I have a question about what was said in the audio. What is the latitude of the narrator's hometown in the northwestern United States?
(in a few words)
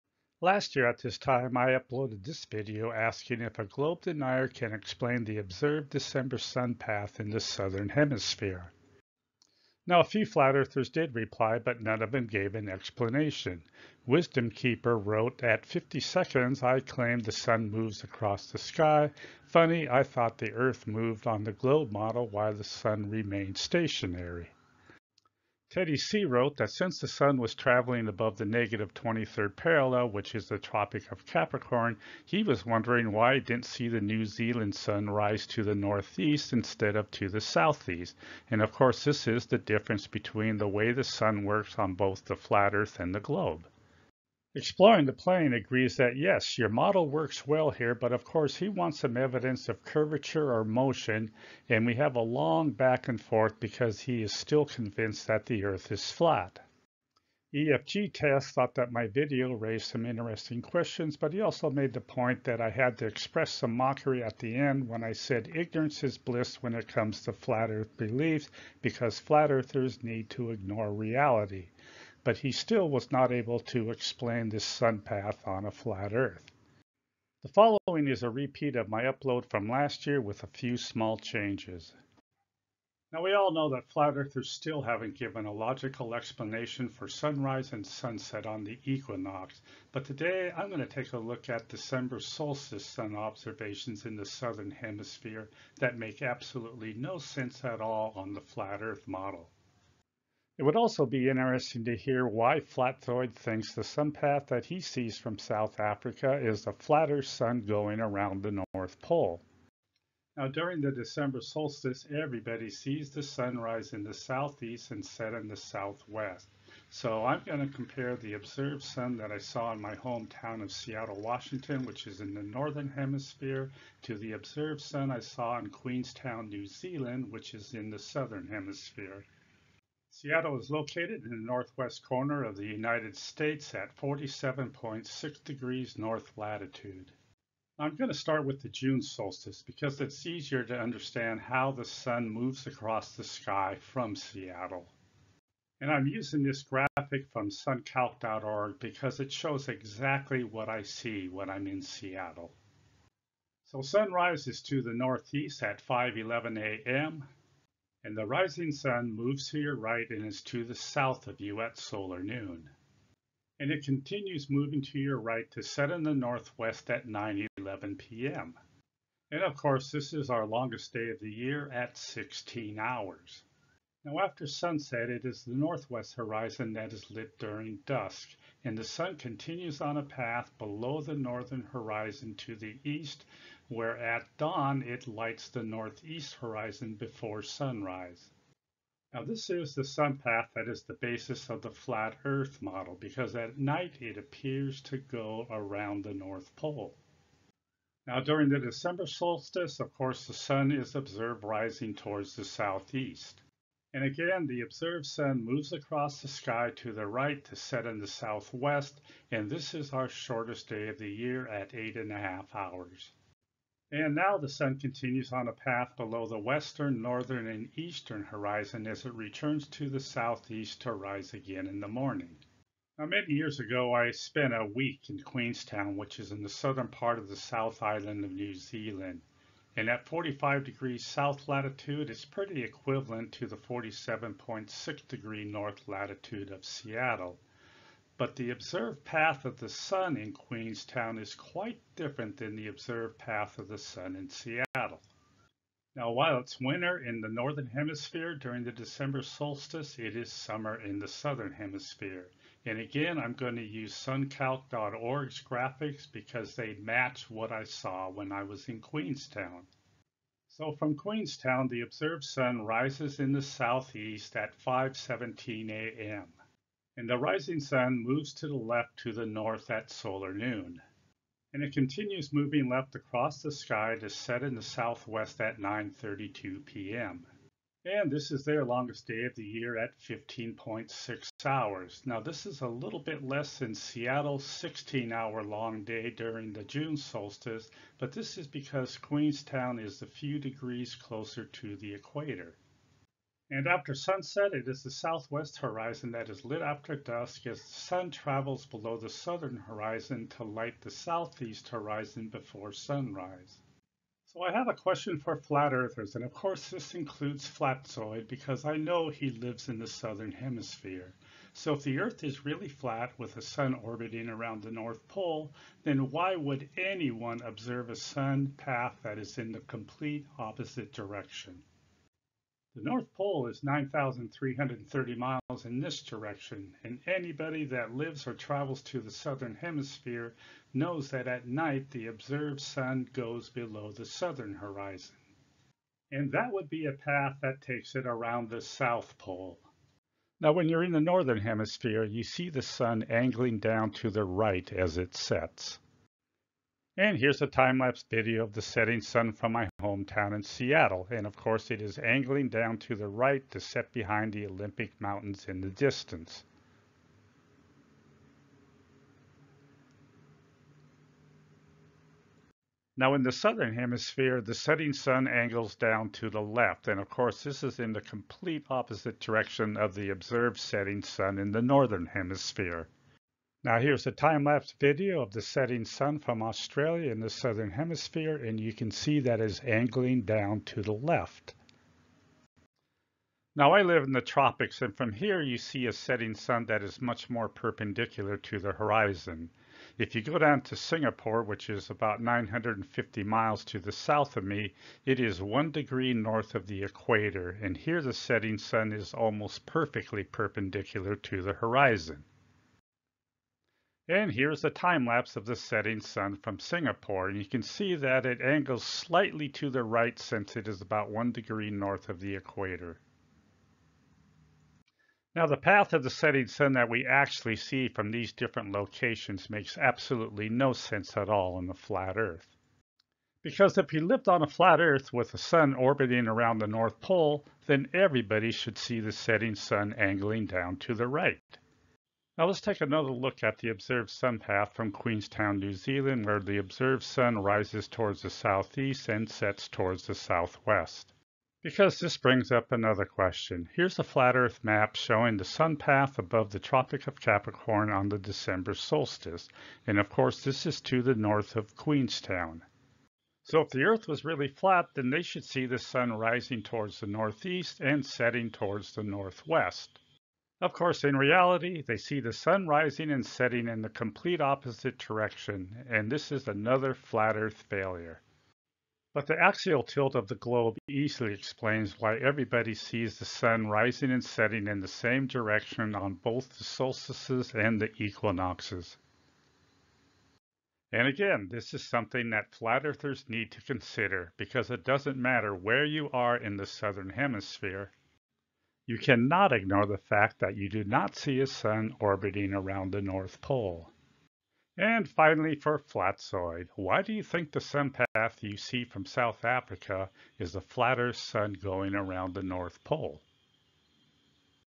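47.6 degrees north.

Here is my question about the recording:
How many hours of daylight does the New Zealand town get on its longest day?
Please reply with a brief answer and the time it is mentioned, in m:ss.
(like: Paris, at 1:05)
15.6 hours, at 4:39.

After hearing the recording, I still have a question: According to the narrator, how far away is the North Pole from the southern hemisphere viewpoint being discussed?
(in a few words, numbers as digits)
9,330 miles.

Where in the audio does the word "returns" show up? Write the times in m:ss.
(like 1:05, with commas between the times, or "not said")
3:39.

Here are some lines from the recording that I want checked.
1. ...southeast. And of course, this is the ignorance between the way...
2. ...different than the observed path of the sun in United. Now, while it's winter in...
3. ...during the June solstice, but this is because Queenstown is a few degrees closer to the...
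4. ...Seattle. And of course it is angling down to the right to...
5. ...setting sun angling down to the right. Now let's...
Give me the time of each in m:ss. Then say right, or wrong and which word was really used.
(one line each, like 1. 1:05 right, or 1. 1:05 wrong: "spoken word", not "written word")
1. 0:37 wrong: "difference", not "ignorance"
2. 4:01 wrong: "Seattle", not "United"
3. 4:46 right
4. 5:50 right
5. 7:09 right.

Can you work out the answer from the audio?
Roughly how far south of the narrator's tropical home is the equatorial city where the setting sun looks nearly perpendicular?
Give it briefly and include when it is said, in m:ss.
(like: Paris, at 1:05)
950 miles, at 6:31.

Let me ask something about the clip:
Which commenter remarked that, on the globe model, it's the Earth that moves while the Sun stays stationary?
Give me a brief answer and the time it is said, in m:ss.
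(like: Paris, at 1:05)
Wisdom Keeper, at 0:14.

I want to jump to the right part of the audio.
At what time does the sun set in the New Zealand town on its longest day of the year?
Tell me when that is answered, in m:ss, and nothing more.
4:35.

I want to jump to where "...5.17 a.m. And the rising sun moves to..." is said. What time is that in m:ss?
4:24.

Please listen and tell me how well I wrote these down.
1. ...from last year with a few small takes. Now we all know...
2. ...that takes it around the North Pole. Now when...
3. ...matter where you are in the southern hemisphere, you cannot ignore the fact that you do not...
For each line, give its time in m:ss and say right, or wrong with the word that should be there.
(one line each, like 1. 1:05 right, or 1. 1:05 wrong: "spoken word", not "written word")
1. 1:19 wrong: "changes", not "takes"
2. 5:37 wrong: "South", not "North"
3. 8:05 right.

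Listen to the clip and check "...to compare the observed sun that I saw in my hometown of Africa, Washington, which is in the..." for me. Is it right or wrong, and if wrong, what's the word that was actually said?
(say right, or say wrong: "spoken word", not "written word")
wrong: "Seattle", not "Africa".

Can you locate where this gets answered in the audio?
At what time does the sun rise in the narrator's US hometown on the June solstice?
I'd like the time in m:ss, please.
2:35.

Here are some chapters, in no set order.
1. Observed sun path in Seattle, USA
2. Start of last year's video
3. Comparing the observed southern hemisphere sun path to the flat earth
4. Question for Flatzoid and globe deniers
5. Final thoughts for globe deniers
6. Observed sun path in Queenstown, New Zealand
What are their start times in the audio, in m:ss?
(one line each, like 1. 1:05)
1. 2:10
2. 1:22
3. 7:12
4. 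5:04
5. 8:00
6. 3:42.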